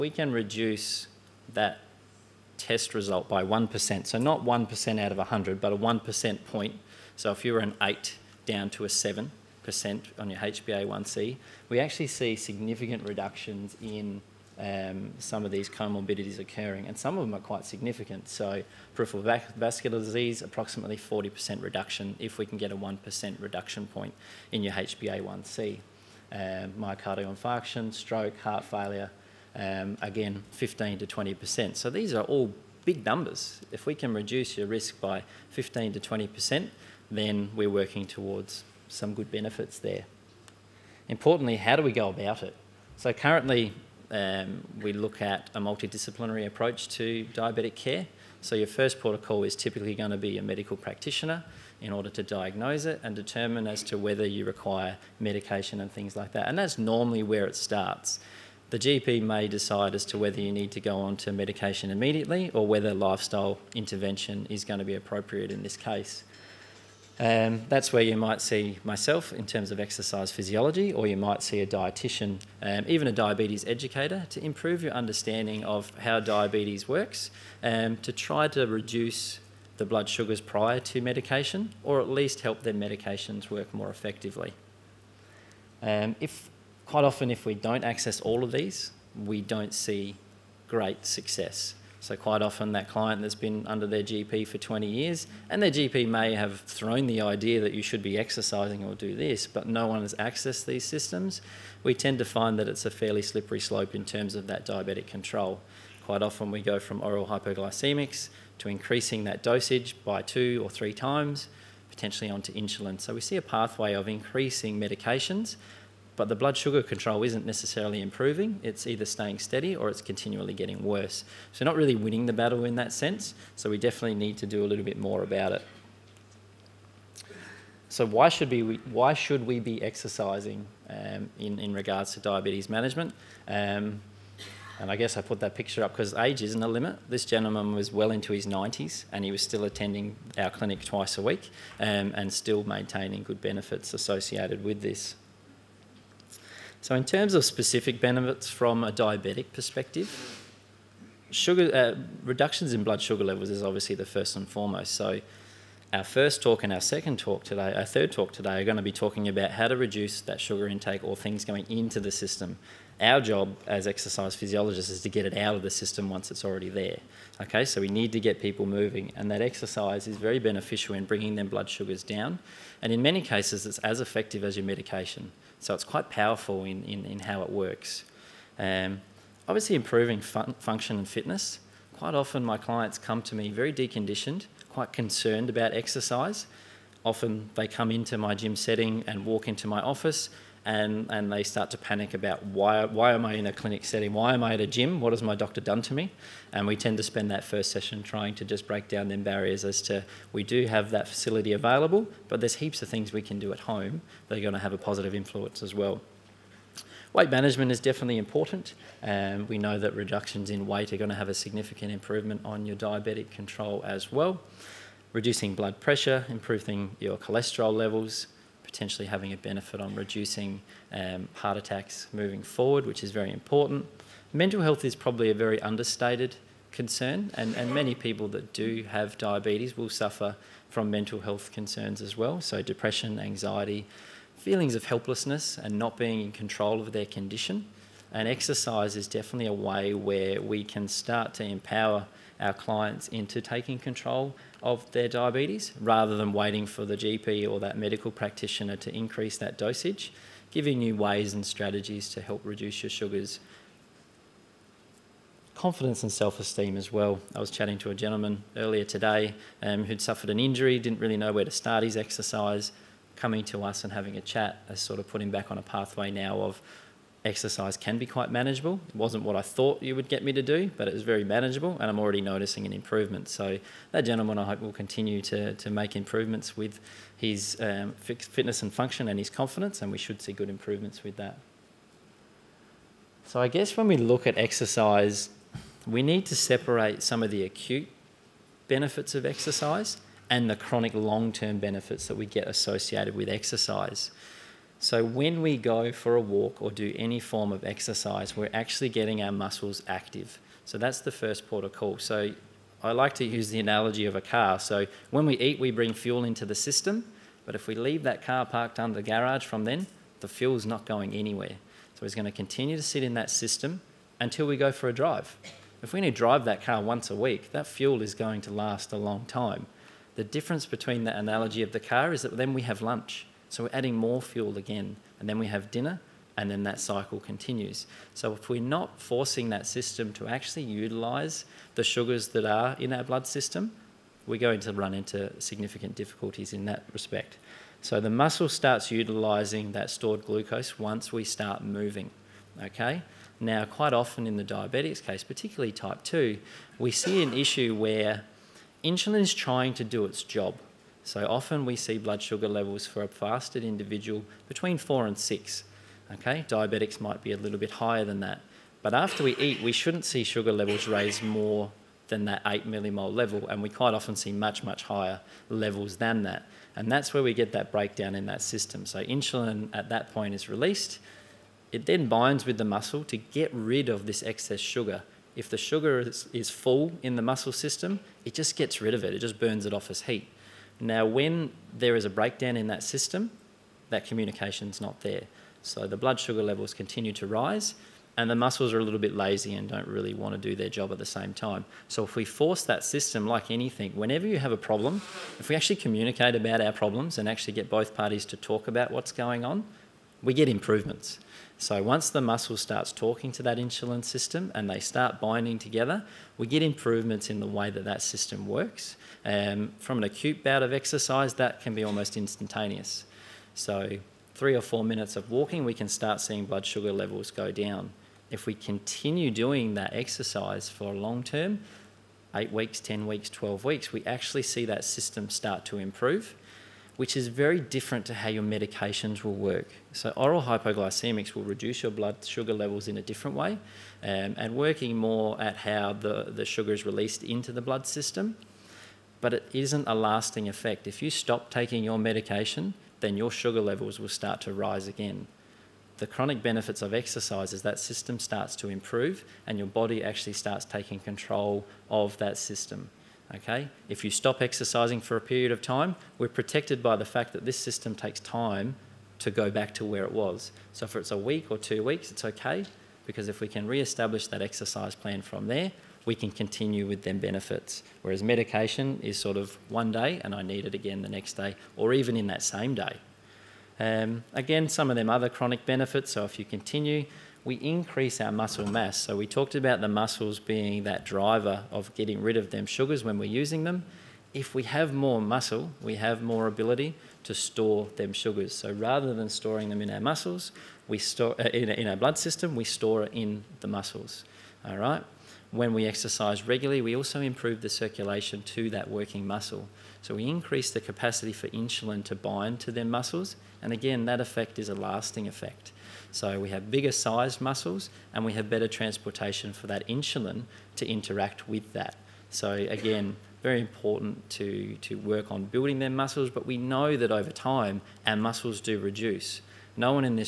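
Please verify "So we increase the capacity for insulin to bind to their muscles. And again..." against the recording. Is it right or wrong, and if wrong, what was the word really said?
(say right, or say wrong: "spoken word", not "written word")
right.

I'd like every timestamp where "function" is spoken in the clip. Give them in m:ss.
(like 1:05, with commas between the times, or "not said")
3:00, 4:38.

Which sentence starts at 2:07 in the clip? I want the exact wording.
So why should we, why should we be exercising um, in, in regards to diabetes management?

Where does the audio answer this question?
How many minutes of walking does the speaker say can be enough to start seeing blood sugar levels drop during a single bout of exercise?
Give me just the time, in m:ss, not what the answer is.
6:54.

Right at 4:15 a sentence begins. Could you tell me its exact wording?
Confidence and self esteem as well.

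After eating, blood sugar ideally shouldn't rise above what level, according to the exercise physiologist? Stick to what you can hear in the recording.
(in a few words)
8 millimole.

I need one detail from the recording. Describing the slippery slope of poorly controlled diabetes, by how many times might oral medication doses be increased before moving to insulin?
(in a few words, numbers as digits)
2 or 3 times.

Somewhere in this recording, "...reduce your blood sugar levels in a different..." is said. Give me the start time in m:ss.
7:11.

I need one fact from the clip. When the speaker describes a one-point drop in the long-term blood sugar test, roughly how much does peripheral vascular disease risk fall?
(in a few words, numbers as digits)
40%.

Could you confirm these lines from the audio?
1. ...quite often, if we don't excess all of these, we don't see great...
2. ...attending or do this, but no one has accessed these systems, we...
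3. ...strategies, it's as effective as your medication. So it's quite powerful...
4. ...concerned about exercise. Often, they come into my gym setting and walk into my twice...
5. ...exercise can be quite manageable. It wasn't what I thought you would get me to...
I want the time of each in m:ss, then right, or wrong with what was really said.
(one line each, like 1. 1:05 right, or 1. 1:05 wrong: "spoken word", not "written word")
1. 1:26 wrong: "access", not "excess"
2. 1:38 wrong: "exercising", not "attending"
3. 2:53 wrong: "cases", not "strategies"
4. 3:04 wrong: "office", not "twice"
5. 4:27 right.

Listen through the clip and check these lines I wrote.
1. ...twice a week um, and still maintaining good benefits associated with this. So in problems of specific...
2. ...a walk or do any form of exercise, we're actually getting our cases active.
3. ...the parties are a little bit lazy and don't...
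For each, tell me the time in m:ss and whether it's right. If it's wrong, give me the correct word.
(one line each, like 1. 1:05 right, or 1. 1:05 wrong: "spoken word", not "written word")
1. 2:20 wrong: "terms", not "problems"
2. 4:56 wrong: "muscles", not "cases"
3. 6:28 wrong: "muscles", not "parties".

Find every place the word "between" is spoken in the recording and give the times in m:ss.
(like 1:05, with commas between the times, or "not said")
5:20, 5:54.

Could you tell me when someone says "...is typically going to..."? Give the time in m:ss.
0:49.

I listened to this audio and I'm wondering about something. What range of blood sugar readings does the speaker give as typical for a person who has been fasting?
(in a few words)
4 to 6.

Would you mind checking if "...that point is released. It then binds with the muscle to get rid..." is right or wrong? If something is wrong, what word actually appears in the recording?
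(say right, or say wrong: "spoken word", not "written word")
right.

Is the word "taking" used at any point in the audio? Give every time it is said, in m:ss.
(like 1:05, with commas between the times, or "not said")
4:03, 7:21, 7:30.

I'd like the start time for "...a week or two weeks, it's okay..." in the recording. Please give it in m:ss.
7:41.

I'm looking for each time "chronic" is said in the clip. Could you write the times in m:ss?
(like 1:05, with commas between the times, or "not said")
4:50, 7:26, 7:55.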